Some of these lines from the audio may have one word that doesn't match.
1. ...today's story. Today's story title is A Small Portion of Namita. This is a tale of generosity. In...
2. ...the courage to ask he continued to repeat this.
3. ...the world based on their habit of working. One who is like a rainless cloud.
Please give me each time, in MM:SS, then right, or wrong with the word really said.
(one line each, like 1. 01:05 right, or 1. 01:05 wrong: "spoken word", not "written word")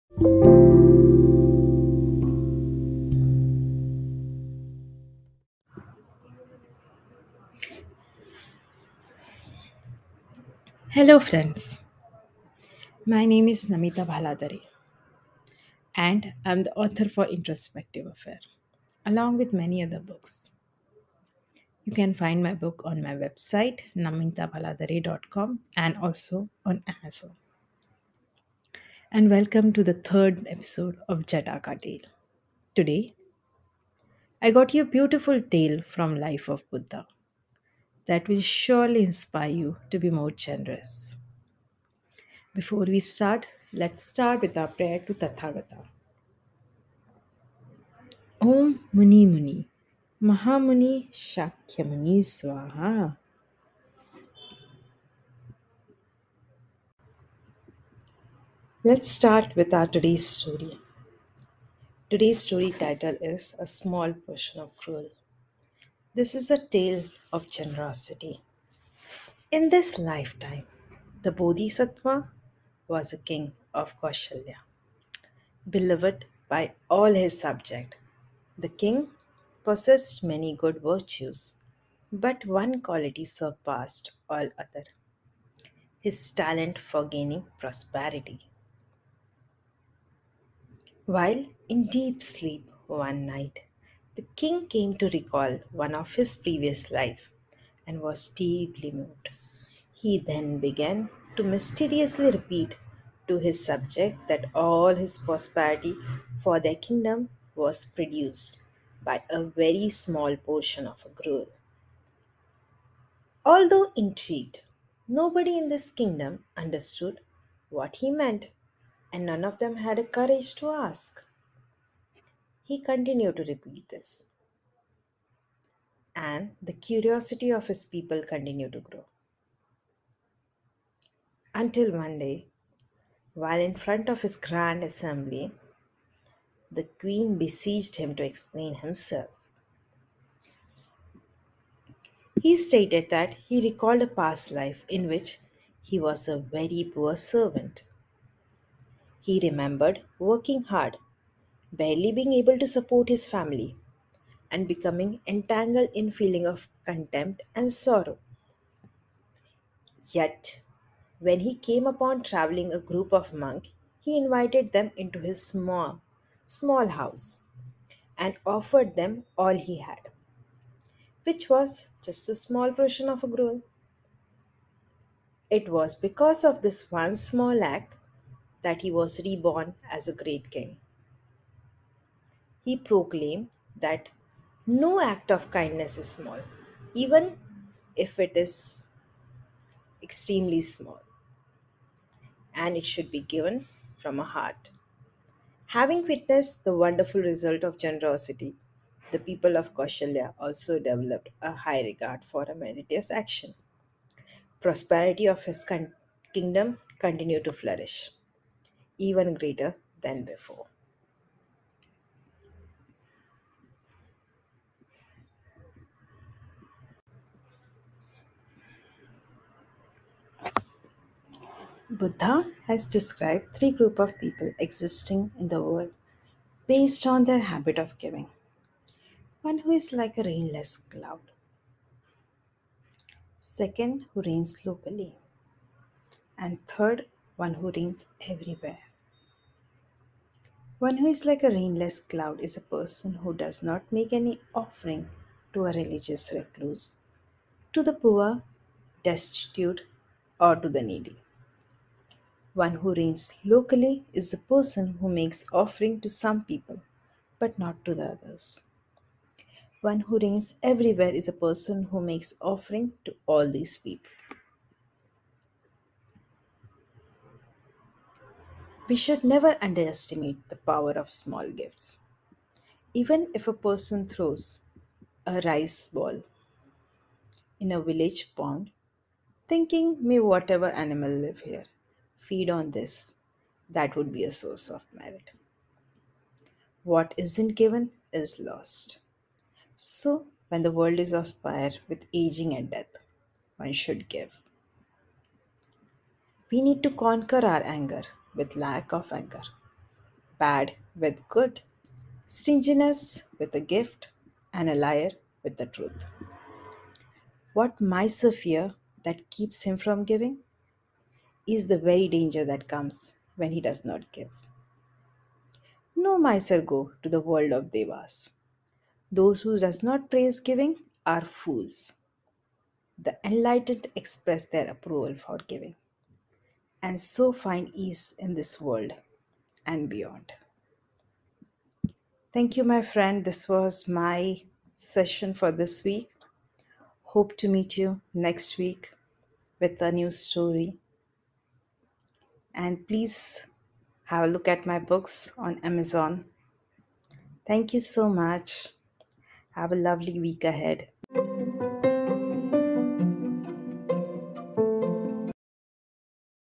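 1. 00:59 wrong: "Gruel", not "Namita"
2. 01:59 right
3. 03:45 wrong: "giving", not "working".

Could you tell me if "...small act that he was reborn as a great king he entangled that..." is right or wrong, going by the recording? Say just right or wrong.
wrong.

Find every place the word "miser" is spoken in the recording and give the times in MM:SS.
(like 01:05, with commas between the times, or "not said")
05:07, 05:16.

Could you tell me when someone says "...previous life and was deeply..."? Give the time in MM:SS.
01:36.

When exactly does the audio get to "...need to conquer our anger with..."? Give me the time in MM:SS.
04:56.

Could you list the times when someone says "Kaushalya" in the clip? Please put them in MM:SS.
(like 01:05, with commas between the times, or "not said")
01:13, 03:19.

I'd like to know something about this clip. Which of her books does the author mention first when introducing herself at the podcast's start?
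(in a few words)
Introspective Affair.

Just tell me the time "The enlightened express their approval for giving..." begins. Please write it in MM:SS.
05:22.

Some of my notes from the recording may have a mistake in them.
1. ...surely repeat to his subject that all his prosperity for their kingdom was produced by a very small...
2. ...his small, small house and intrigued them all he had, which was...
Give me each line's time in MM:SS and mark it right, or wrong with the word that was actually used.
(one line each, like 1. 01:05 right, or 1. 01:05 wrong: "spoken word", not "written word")
1. 01:41 wrong: "mysteriously", not "surely"
2. 02:45 wrong: "offered", not "intrigued".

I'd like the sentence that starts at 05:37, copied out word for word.
Hope to meet you next week with a new story and please have a look at my books on Amazon.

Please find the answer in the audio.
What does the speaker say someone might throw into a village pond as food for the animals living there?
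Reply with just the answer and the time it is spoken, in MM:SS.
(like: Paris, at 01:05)
A rice ball, at 04:35.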